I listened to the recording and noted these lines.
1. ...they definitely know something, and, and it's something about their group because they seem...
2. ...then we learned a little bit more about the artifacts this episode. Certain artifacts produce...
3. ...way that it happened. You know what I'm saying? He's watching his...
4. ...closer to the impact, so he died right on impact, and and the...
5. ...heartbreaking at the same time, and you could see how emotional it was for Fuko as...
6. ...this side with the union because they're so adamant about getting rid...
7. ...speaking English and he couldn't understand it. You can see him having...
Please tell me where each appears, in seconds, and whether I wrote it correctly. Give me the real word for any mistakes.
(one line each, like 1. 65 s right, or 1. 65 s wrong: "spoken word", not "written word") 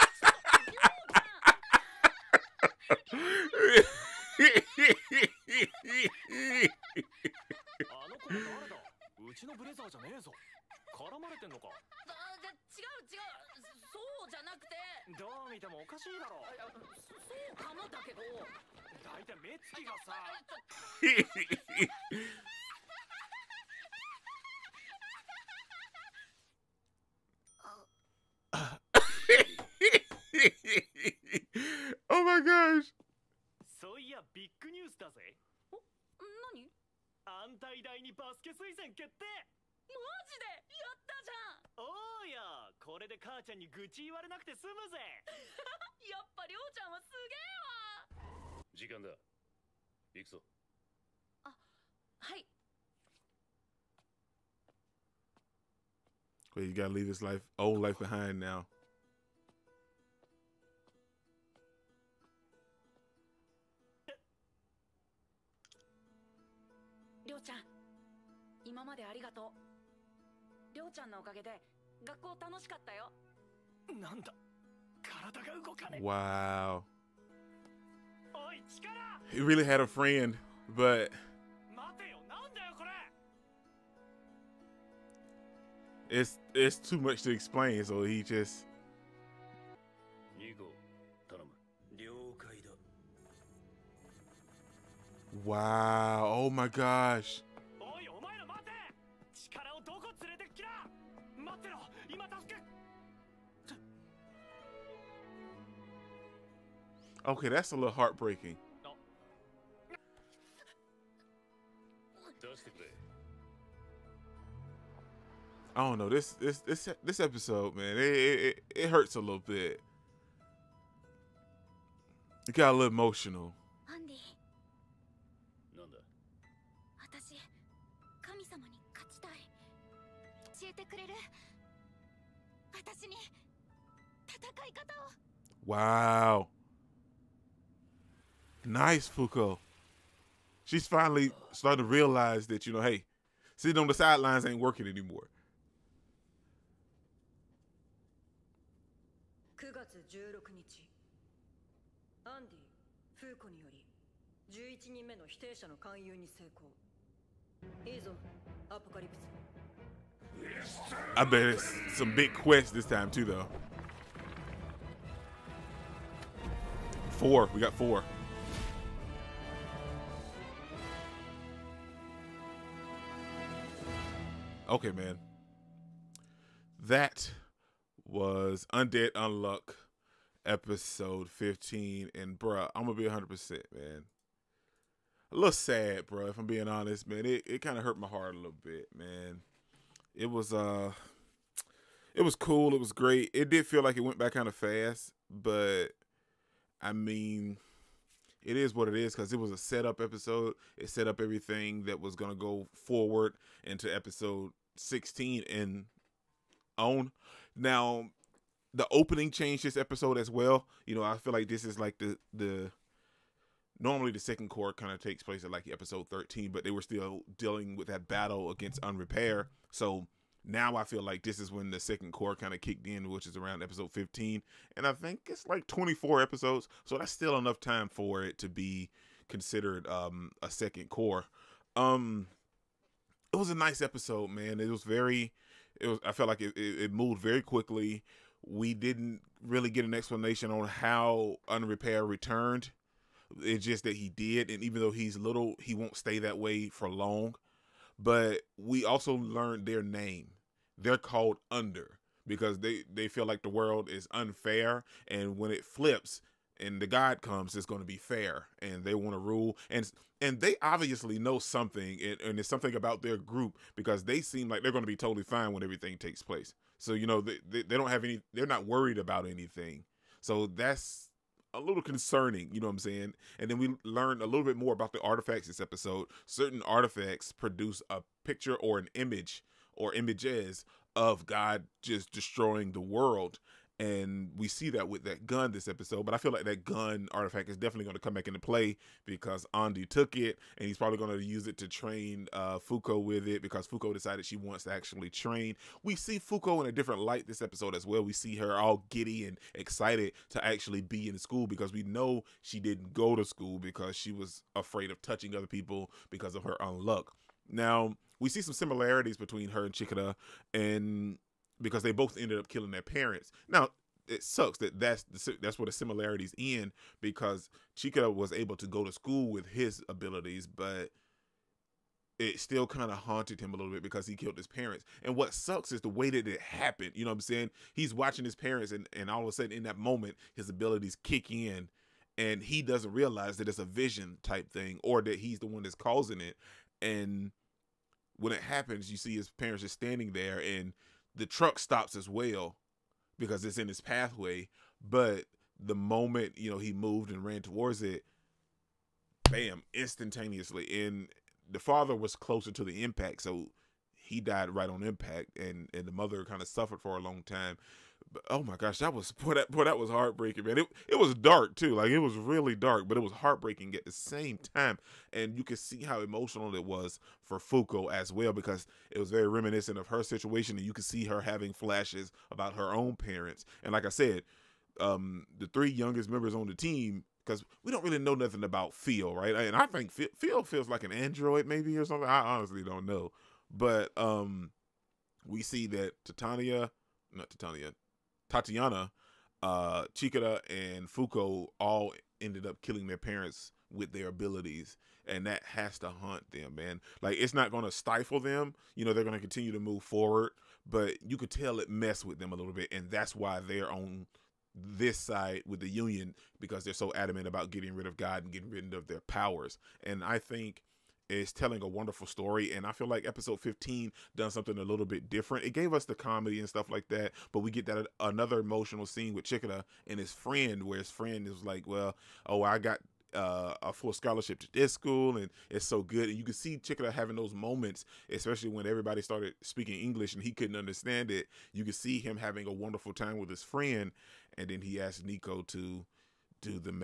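1. 260 s wrong: "obviously", not "definitely"
2. 273 s right
3. 325 s right
4. 352 s right
5. 363 s right
6. 404 s right
7. 429 s right.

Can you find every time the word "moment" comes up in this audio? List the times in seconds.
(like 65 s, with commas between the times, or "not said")
329 s, 345 s, 427 s.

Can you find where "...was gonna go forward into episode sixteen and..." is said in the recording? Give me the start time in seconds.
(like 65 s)
201 s.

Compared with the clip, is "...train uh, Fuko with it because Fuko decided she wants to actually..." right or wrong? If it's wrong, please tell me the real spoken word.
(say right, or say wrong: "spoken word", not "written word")
right.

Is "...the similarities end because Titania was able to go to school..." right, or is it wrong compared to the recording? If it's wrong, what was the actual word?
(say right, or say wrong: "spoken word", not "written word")
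wrong: "Chica", not "Titania".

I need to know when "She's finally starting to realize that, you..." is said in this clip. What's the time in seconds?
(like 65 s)
140 s.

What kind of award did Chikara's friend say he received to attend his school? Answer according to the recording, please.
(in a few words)
A full scholarship.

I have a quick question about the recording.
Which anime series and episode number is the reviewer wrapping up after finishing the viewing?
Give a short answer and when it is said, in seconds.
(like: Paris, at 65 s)
Undead Unluck episode 15, at 178 s.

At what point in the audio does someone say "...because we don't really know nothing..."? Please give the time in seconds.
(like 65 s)
377 s.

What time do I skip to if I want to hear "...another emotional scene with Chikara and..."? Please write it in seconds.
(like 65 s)
417 s.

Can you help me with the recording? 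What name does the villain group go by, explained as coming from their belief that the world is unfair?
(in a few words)
Under.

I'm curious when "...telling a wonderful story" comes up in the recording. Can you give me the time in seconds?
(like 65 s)
411 s.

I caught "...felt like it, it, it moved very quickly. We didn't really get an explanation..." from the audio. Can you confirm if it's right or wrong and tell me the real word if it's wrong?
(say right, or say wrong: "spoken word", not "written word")
right.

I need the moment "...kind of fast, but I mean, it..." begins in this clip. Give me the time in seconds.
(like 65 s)
194 s.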